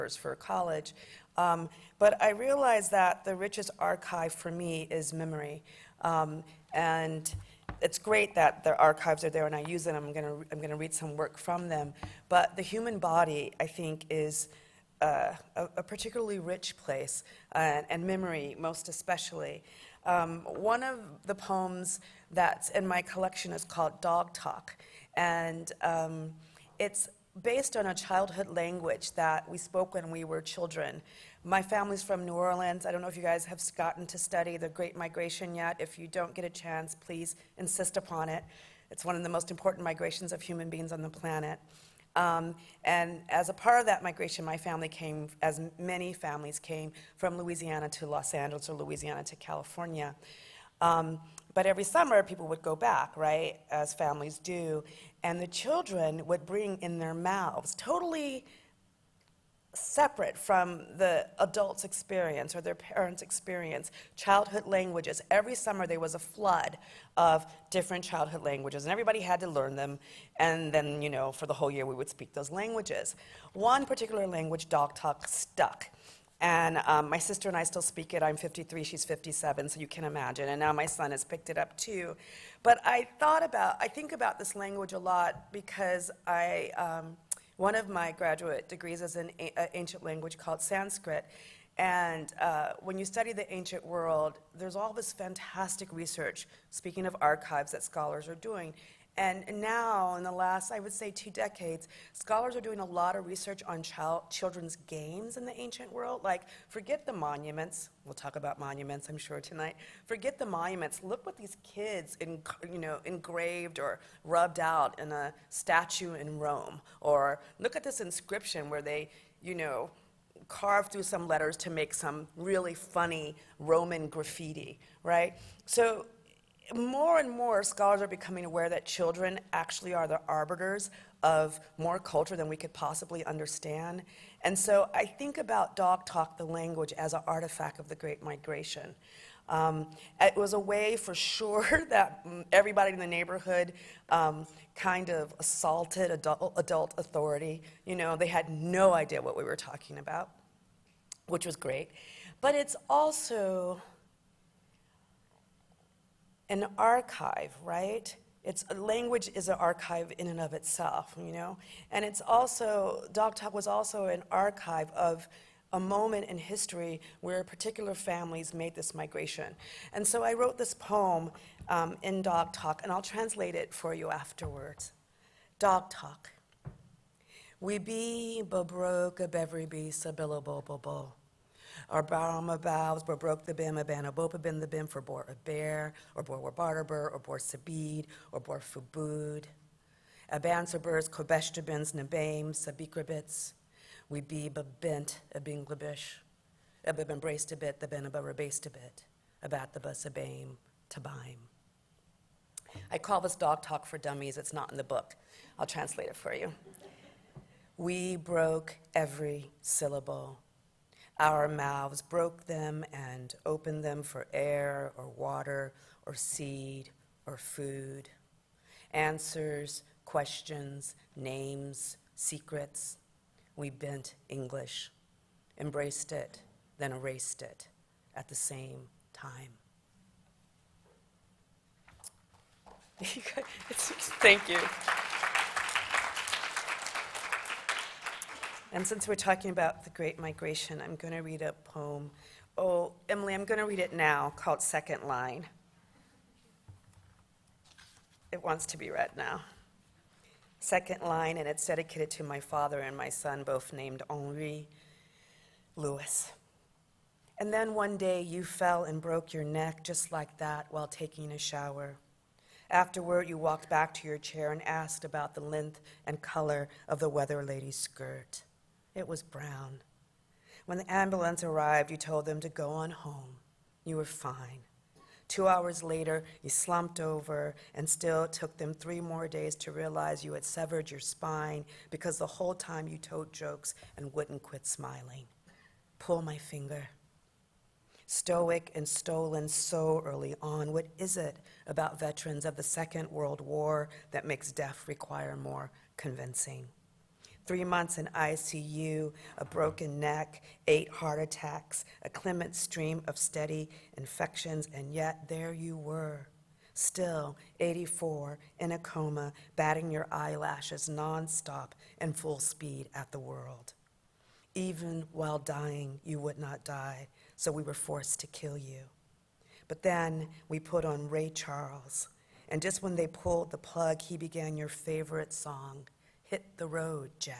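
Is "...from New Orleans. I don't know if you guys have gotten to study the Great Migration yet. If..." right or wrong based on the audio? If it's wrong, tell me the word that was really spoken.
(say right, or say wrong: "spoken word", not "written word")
right.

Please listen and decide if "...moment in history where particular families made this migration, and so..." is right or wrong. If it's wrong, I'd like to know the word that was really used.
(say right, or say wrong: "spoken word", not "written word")
right.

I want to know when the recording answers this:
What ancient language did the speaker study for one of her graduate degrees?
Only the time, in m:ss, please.
1:30.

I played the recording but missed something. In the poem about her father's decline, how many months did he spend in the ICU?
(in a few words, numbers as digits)
3.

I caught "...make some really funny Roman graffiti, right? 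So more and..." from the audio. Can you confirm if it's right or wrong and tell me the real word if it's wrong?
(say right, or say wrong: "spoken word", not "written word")
right.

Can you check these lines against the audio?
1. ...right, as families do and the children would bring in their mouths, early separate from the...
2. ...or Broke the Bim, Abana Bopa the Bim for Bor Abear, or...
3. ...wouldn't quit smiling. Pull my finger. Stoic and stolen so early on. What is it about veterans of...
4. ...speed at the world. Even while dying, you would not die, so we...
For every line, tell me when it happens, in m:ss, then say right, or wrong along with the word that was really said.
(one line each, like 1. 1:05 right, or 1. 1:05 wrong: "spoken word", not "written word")
1. 0:53 wrong: "totally", not "early"
2. 3:03 right
3. 4:44 right
4. 5:12 right.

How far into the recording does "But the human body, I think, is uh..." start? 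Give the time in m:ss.
0:12.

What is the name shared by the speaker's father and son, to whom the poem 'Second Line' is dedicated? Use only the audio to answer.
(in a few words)
Henri Louis.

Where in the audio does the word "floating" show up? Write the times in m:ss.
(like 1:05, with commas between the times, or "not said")
not said.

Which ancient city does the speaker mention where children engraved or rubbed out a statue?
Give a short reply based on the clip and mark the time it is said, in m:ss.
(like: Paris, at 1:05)
Rome, at 1:56.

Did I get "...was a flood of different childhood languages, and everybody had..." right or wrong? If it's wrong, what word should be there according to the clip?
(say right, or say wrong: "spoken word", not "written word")
right.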